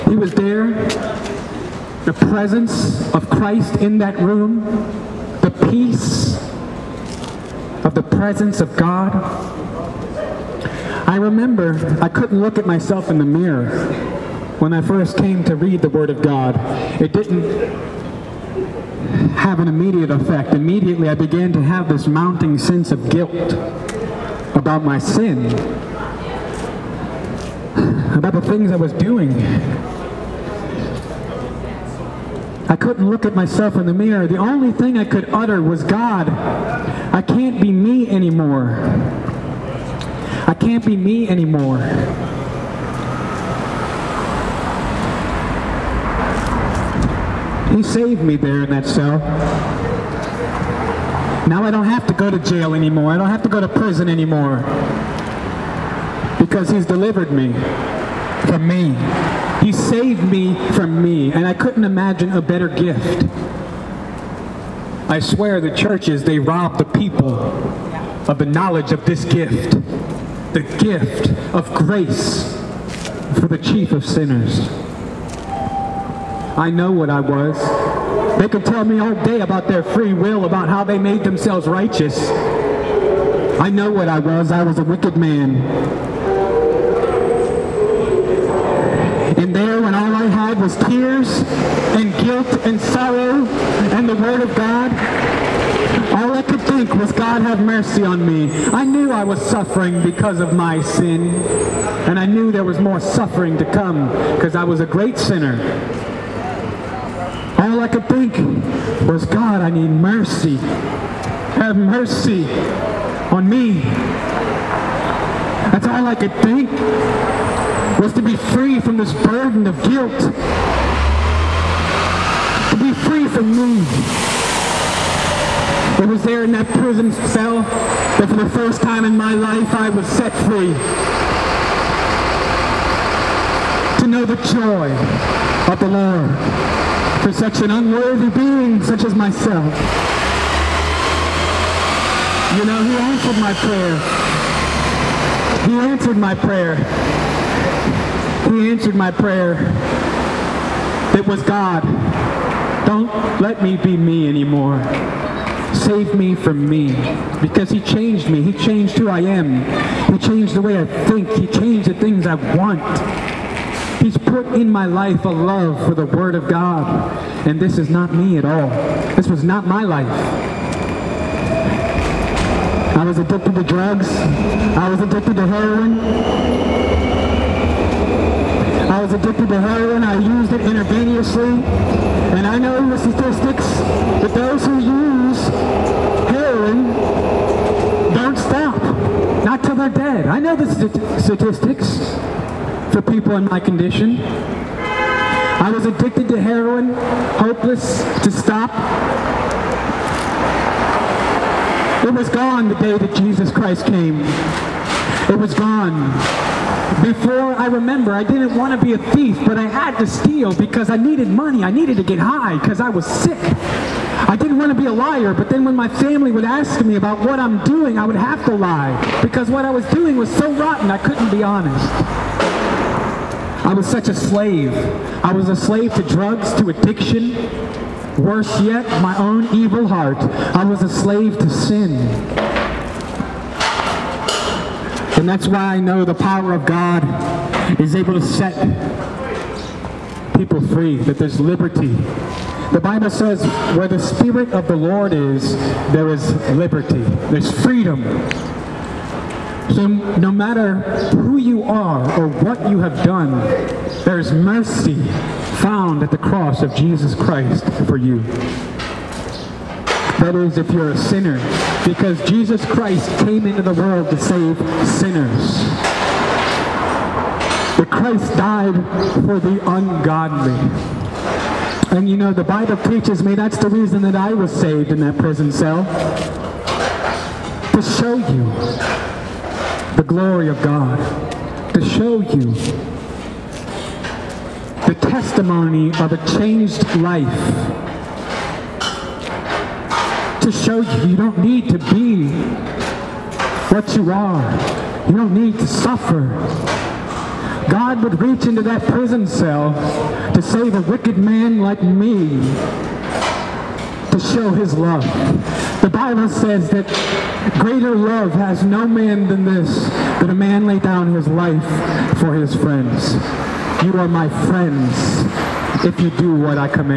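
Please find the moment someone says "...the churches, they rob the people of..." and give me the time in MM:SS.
01:05.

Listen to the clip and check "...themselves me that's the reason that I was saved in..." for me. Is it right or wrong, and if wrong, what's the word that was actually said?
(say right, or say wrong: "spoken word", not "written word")
wrong: "teaches", not "themselves".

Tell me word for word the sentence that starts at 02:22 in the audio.
You know, he answered my prayer.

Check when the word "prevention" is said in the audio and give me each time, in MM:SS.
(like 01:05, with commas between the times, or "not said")
not said.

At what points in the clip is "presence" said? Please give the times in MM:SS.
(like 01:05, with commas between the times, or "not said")
00:02, 00:08.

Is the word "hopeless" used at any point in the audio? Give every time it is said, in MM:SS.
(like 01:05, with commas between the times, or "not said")
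03:17.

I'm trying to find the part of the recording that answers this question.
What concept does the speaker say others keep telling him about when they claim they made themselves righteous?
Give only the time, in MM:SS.
01:19.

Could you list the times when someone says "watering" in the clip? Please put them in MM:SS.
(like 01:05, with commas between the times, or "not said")
not said.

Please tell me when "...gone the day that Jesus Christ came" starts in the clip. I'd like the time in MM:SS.
03:22.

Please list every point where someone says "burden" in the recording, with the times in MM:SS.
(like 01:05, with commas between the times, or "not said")
01:59.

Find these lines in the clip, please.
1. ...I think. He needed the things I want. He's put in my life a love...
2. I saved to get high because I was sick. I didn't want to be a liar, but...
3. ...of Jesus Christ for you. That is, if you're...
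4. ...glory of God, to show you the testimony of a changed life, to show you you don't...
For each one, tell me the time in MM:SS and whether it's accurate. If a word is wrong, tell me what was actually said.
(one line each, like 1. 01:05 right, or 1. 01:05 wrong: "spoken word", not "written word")
1. 02:40 wrong: "changed", not "needed"
2. 03:31 wrong: "needed", not "saved"
3. 04:16 right
4. 04:40 right.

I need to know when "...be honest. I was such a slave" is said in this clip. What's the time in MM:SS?
03:41.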